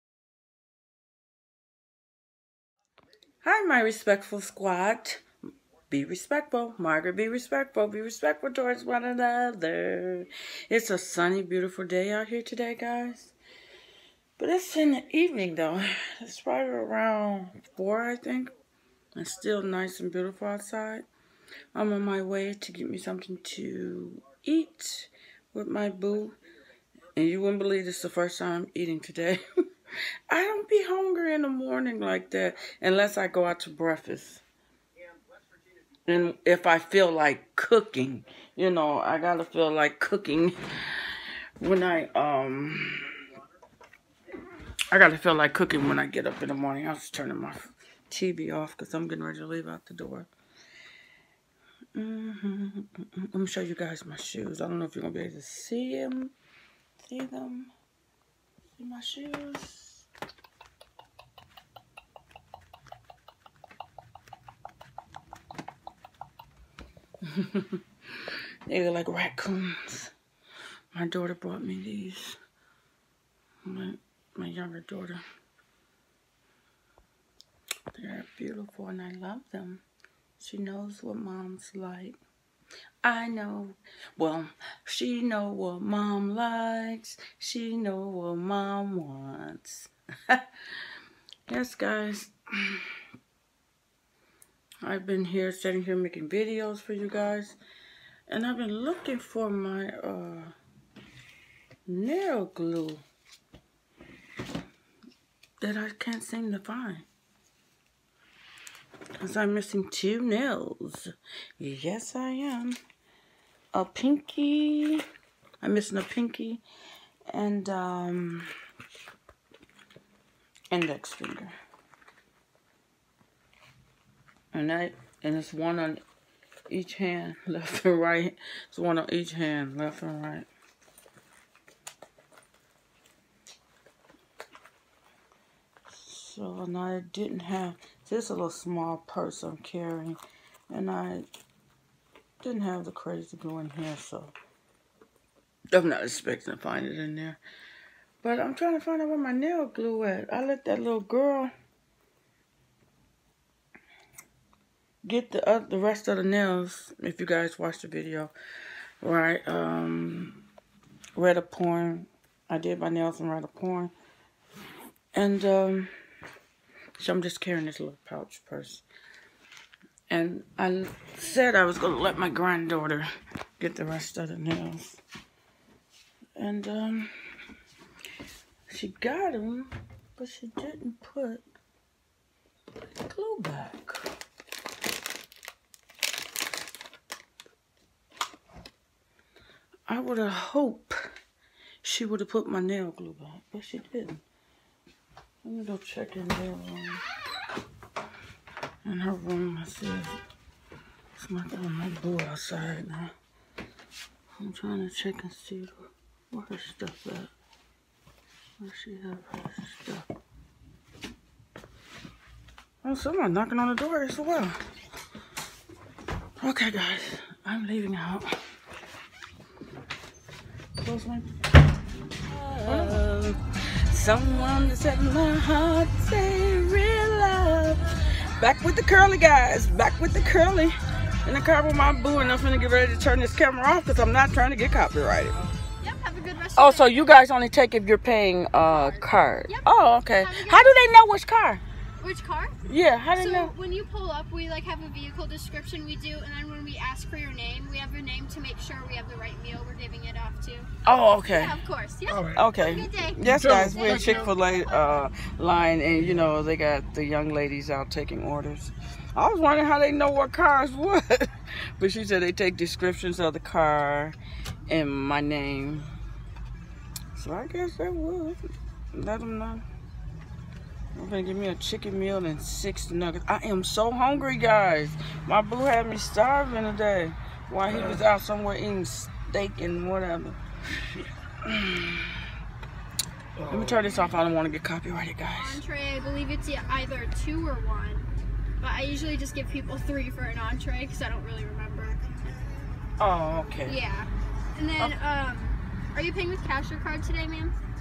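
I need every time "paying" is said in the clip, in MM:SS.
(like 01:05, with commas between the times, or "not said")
03:57, 04:56.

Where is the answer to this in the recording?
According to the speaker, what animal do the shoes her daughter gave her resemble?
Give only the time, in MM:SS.
01:09.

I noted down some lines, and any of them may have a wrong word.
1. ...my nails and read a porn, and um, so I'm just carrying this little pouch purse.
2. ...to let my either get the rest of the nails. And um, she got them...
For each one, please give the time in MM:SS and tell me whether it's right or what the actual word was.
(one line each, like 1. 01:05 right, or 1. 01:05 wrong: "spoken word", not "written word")
1. 02:42 right
2. 02:51 wrong: "granddaughter", not "either".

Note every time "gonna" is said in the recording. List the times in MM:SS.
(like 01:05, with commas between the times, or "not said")
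00:55, 04:31.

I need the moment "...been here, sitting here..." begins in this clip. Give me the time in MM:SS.
01:35.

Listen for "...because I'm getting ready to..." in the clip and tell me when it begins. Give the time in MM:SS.
00:48.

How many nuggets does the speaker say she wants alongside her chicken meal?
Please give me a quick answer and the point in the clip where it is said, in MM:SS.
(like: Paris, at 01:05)
6, at 04:32.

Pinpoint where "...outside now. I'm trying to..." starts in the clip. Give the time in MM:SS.
03:22.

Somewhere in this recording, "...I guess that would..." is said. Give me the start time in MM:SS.
04:27.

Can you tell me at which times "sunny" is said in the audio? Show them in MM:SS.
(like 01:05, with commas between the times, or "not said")
00:10.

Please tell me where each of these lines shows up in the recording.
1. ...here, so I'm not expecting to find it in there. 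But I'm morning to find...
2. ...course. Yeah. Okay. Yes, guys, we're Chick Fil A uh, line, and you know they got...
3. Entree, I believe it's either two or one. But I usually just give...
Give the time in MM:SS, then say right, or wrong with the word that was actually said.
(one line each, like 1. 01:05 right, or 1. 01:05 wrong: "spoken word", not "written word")
1. 02:23 wrong: "trying", not "morning"
2. 04:11 right
3. 04:45 right.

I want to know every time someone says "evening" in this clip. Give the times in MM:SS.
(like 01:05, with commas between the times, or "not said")
00:15.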